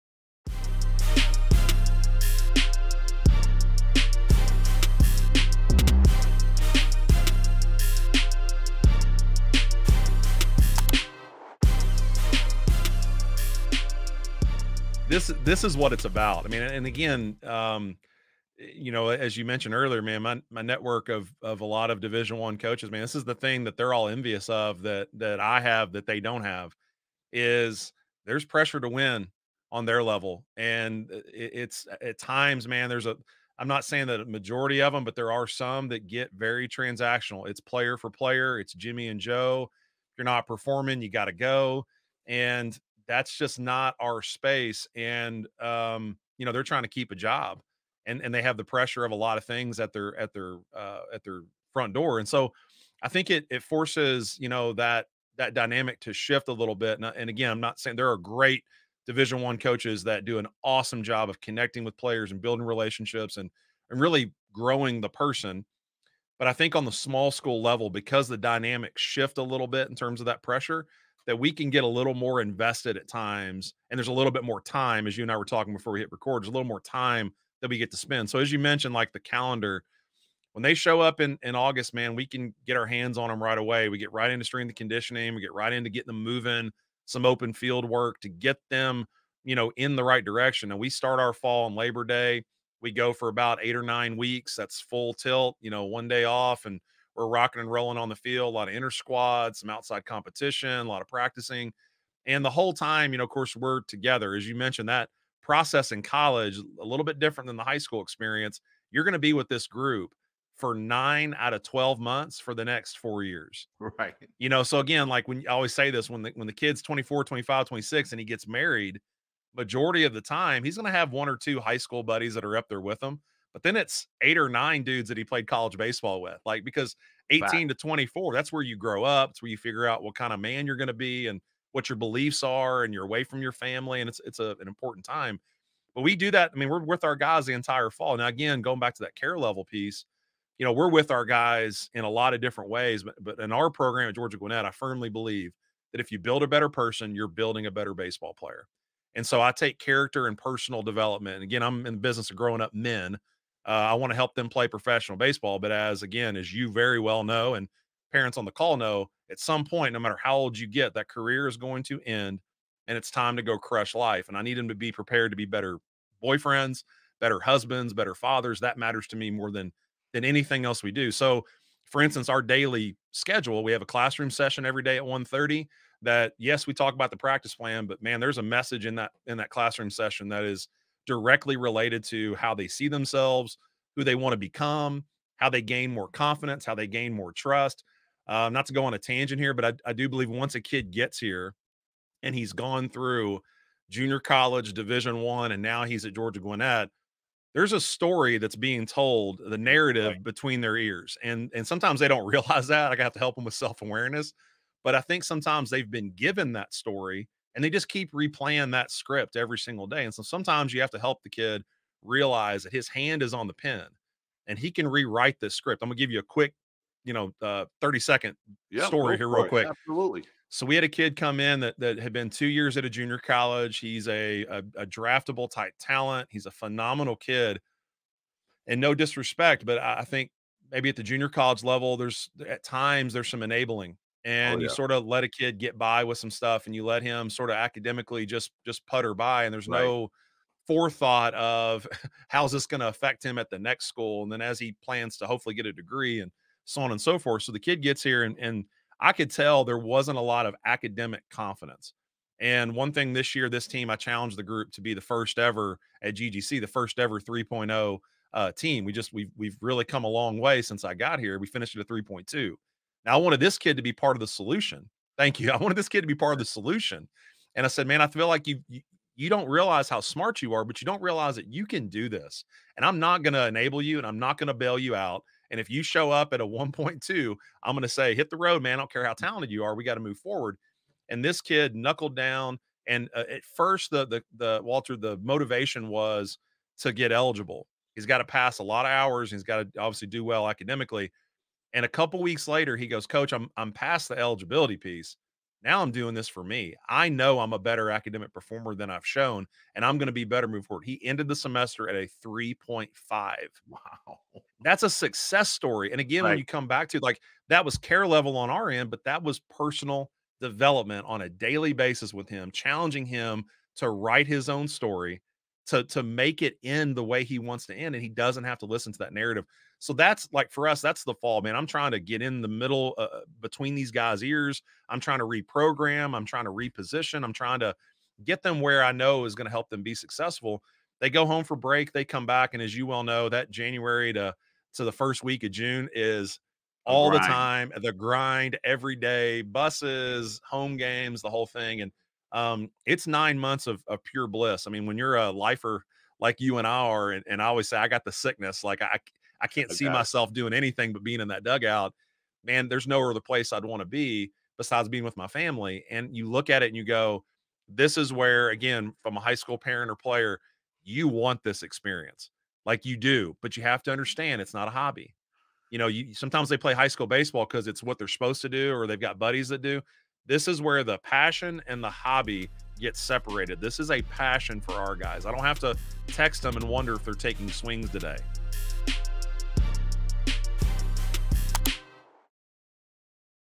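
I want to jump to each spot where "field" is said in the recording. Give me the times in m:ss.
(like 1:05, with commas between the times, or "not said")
1:27, 1:38.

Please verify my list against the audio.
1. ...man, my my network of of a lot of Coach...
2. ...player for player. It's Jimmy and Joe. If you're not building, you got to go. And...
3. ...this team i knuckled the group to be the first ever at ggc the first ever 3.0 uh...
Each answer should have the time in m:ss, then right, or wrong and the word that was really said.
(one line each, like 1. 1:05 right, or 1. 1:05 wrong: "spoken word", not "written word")
1. 0:20 wrong: "Division", not "Coach"
2. 0:37 wrong: "performing", not "building"
3. 4:13 wrong: "challenged", not "knuckled".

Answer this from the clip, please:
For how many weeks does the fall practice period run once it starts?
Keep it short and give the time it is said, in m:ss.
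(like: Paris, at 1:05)
8 or 9, at 1:33.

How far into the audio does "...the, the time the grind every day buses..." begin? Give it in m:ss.
5:37.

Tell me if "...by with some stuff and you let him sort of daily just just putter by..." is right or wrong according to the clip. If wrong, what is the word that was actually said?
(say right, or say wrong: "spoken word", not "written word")
wrong: "academically", not "daily".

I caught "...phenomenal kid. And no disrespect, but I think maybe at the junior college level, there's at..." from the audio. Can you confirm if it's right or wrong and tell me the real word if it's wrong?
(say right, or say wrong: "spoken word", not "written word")
right.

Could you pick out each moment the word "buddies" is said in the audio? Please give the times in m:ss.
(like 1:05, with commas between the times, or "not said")
2:02, 6:09.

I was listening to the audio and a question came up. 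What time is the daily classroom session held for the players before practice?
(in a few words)
1:30.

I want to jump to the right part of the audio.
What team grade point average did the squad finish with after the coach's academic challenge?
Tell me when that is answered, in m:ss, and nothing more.
4:21.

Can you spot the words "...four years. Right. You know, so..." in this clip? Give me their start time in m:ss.
1:52.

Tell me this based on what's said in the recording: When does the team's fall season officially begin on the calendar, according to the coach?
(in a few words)
Labor Day.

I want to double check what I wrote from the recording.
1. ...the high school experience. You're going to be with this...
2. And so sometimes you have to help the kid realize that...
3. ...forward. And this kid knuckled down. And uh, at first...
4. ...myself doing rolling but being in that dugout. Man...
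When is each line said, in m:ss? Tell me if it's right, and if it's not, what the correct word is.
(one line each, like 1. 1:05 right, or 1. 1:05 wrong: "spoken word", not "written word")
1. 1:47 right
2. 3:30 right
3. 4:40 right
4. 5:49 wrong: "anything", not "rolling".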